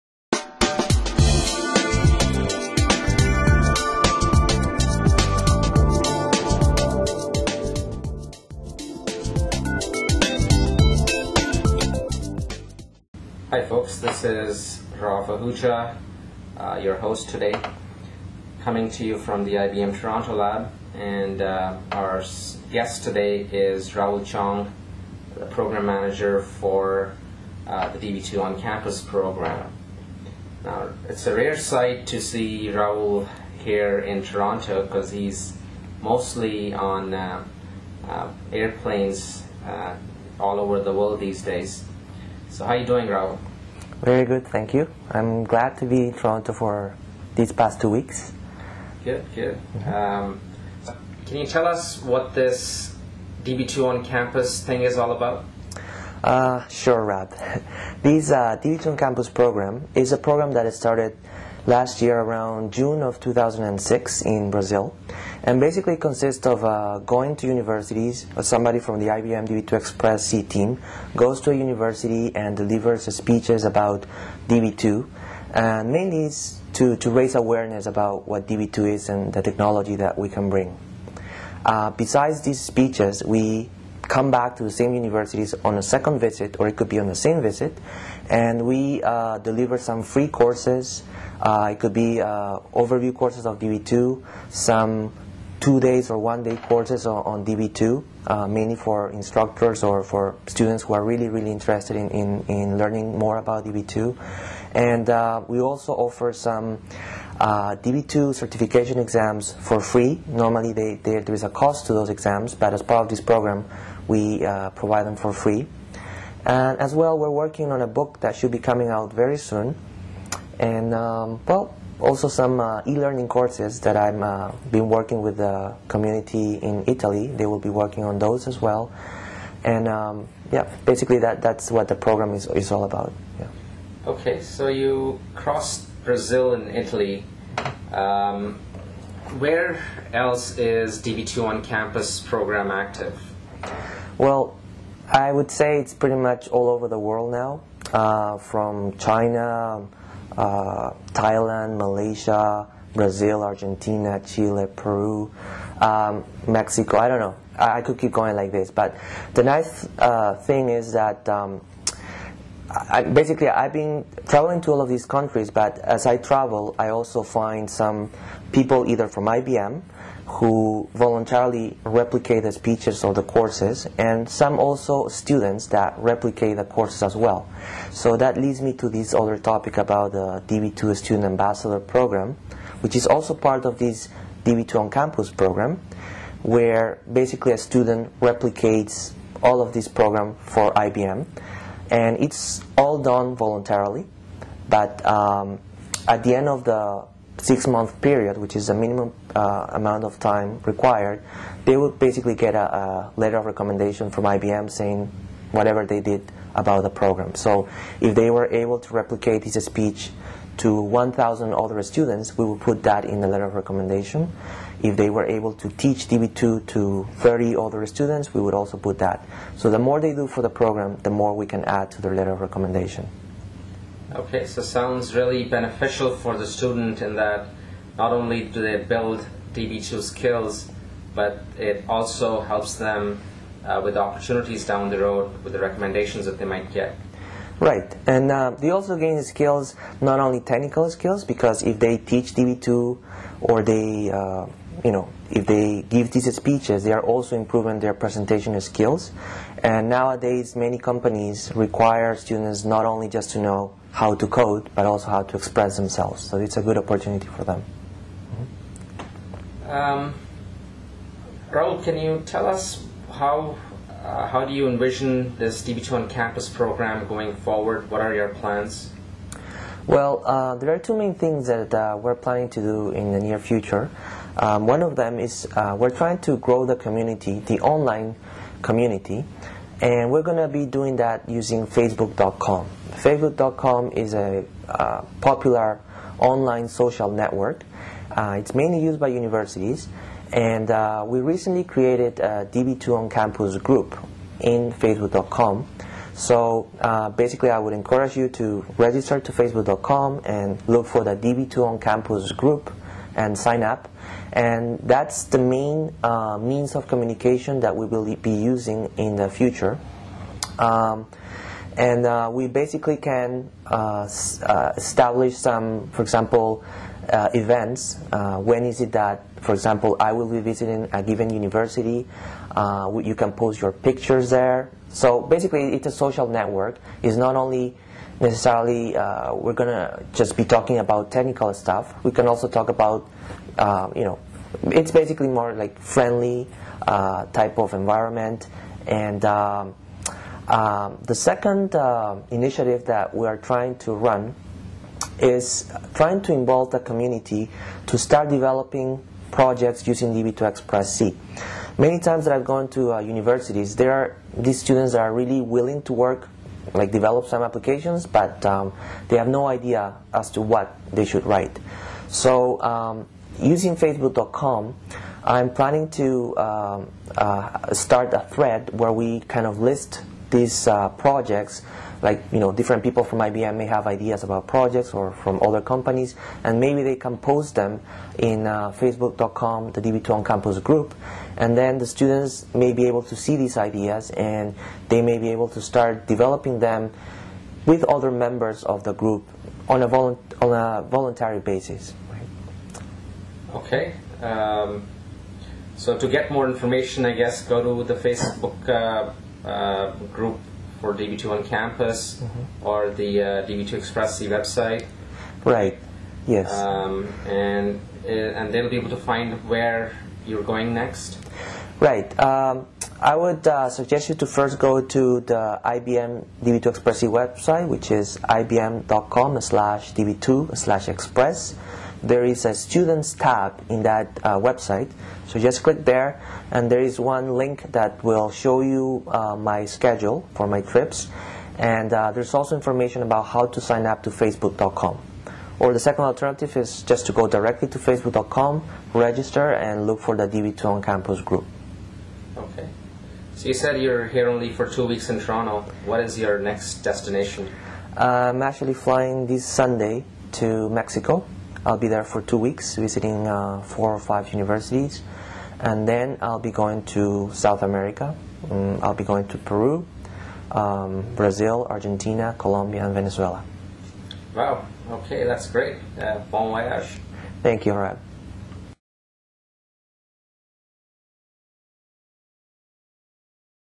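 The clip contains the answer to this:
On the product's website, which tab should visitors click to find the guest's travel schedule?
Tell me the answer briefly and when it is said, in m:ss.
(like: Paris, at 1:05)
Students tab, at 7:02.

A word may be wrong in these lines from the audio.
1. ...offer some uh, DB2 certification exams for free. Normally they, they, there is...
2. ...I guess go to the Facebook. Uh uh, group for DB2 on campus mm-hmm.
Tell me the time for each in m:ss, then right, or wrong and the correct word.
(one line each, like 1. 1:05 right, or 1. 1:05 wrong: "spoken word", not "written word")
1. 1:45 right
2. 6:37 right.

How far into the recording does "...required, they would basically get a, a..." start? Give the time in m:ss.
3:20.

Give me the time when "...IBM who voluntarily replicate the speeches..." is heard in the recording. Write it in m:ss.
2:49.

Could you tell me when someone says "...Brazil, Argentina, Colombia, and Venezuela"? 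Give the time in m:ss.
7:41.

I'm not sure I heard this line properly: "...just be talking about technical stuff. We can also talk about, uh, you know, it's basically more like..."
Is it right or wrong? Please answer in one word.
right.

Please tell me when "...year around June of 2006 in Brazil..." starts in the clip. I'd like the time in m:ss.
1:02.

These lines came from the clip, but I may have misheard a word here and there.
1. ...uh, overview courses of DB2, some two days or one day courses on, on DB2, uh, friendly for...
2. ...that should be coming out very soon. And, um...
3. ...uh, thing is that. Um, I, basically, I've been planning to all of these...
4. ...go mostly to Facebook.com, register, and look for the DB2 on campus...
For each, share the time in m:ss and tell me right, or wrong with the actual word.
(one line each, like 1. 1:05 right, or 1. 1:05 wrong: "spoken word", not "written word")
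1. 1:32 wrong: "mainly", not "friendly"
2. 1:58 right
3. 2:39 wrong: "traveling", not "planning"
4. 7:17 wrong: "directly", not "mostly".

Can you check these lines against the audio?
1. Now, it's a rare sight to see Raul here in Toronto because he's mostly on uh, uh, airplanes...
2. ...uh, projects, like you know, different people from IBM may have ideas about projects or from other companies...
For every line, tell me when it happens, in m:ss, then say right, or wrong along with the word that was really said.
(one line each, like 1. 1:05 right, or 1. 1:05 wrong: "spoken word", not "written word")
1. 0:30 right
2. 6:10 right.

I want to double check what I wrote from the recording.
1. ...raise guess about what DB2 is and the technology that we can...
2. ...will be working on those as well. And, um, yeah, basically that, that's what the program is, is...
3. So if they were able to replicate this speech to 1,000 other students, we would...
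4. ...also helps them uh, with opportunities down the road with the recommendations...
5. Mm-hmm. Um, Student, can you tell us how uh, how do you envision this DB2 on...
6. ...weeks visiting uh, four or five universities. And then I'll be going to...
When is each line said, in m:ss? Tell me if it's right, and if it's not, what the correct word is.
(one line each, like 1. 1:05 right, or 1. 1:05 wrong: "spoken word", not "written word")
1. 1:17 wrong: "awareness", not "guess"
2. 2:07 right
3. 3:27 right
4. 3:51 right
5. 4:19 wrong: "Raul", not "Student"
6. 7:32 right.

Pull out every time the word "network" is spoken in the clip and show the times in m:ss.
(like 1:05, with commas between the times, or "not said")
4:47, 5:26.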